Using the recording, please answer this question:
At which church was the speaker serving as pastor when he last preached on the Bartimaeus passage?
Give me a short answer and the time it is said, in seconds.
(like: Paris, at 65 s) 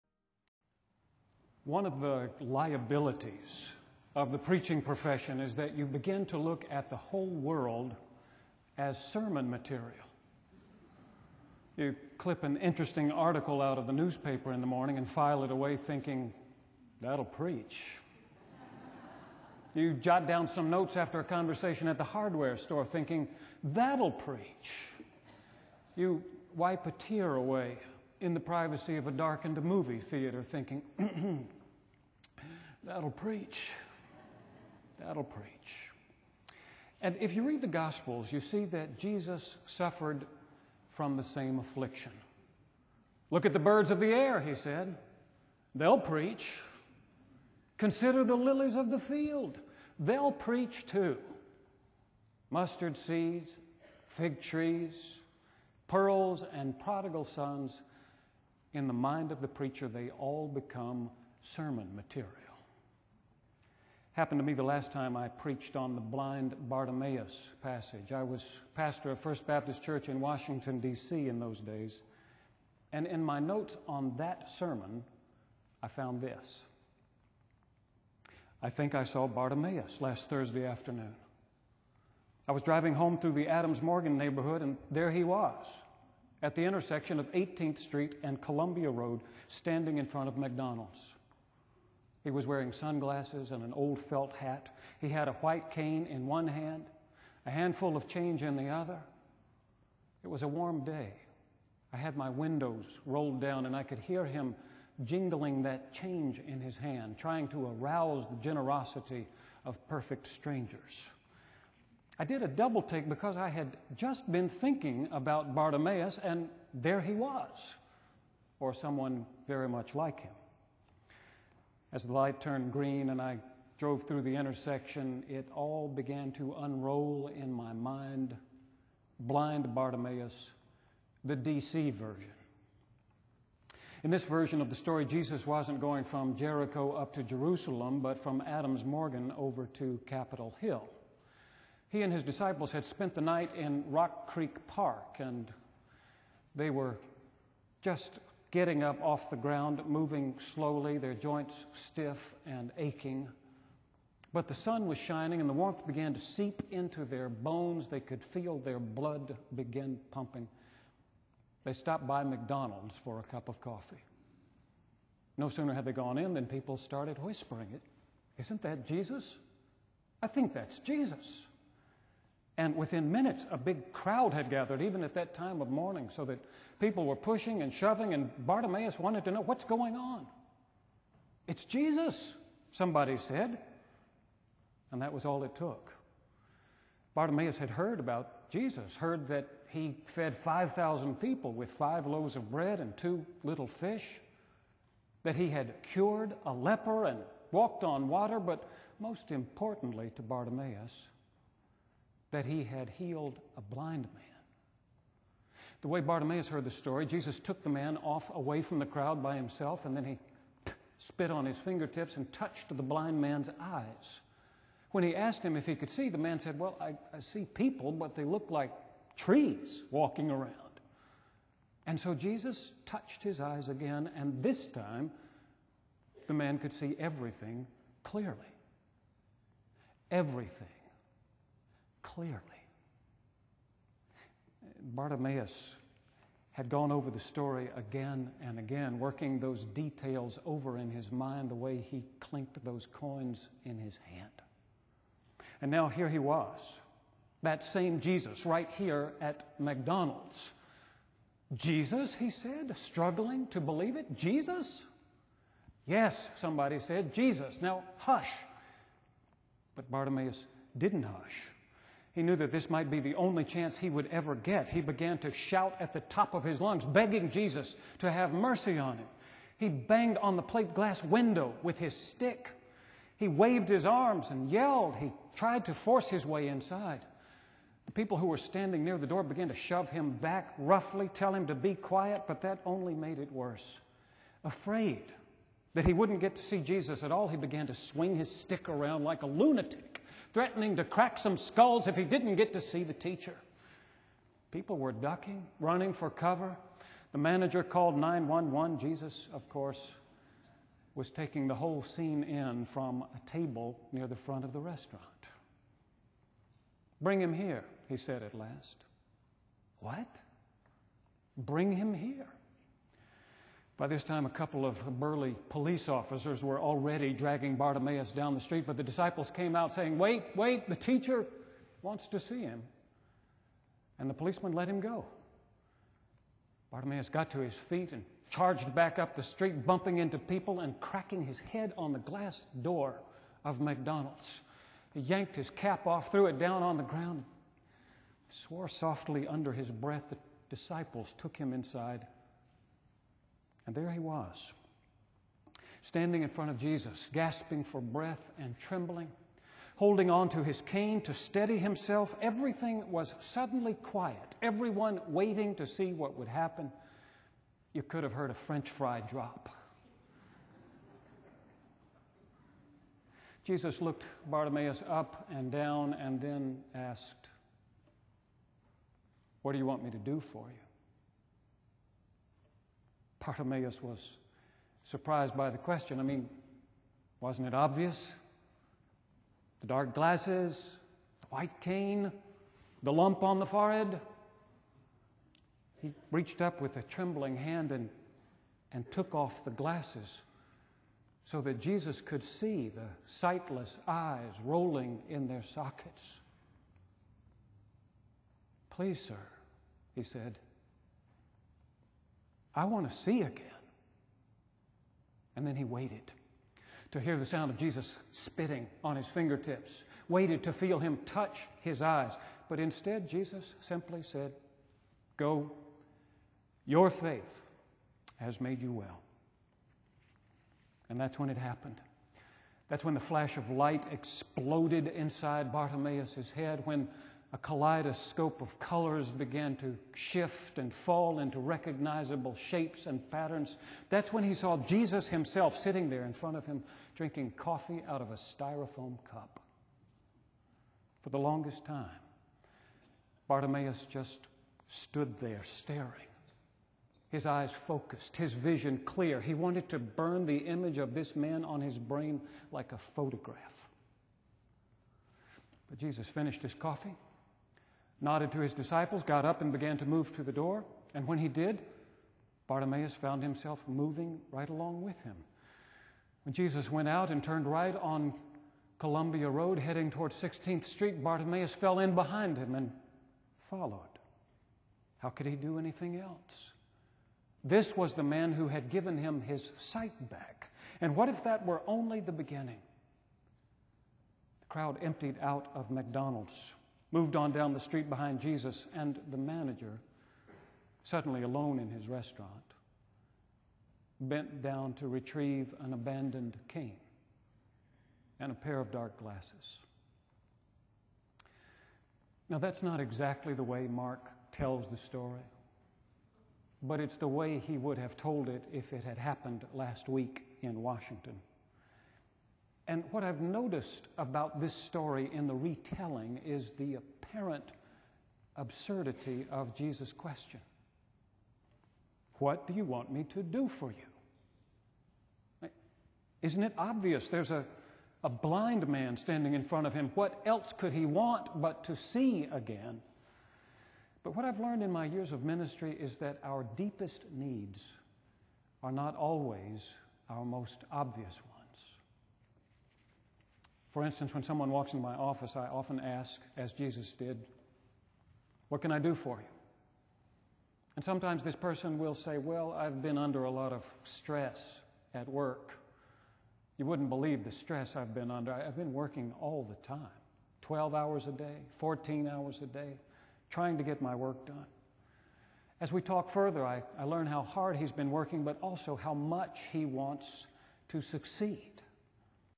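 First Baptist Church, at 69 s.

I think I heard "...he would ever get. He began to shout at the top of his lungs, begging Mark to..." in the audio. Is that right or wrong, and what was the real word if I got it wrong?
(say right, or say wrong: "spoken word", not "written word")
wrong: "Jesus", not "Mark".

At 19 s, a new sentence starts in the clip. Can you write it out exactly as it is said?
you jot down some notes after a conversation at the hardware store thinking, that'll preach.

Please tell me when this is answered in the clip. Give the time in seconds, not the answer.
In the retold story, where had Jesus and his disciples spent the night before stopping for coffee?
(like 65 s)
143 s.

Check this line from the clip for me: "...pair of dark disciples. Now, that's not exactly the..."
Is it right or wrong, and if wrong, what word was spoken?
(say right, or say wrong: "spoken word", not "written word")
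wrong: "glasses", not "disciples".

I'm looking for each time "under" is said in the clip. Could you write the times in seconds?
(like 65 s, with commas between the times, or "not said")
339 s, 552 s, 558 s.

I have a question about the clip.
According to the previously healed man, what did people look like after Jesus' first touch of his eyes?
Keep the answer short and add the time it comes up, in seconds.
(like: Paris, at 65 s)
Trees walking around, at 219 s.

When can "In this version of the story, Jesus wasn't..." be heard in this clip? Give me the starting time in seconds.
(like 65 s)
134 s.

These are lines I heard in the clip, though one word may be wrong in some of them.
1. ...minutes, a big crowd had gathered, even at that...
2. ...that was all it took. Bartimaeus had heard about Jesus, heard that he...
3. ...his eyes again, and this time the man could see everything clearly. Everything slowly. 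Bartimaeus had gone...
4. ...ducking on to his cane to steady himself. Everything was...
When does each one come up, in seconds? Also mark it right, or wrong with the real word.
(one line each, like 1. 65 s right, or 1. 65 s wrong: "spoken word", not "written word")
1. 173 s right
2. 185 s right
3. 223 s wrong: "clearly", not "slowly"
4. 349 s wrong: "holding", not "ducking".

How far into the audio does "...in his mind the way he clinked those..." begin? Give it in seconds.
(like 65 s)
240 s.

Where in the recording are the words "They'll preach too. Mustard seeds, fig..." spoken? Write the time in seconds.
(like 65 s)
49 s.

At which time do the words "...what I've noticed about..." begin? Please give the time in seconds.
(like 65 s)
512 s.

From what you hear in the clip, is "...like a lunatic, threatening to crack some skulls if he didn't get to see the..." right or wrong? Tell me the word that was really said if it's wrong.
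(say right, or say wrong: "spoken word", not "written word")
right.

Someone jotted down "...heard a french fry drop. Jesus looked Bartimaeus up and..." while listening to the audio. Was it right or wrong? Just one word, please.
right.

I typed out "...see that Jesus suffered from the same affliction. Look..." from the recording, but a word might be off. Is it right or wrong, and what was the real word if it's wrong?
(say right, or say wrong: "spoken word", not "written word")
right.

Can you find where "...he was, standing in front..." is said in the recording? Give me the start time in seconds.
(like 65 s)
343 s.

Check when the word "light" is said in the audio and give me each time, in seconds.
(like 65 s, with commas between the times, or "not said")
122 s, 423 s.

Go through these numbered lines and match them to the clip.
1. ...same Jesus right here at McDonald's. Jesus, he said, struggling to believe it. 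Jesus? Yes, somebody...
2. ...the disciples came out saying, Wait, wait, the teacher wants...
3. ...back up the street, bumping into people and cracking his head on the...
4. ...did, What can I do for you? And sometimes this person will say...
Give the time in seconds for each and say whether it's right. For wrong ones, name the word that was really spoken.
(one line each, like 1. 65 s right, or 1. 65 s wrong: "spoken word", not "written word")
1. 247 s right
2. 318 s right
3. 328 s right
4. 546 s right.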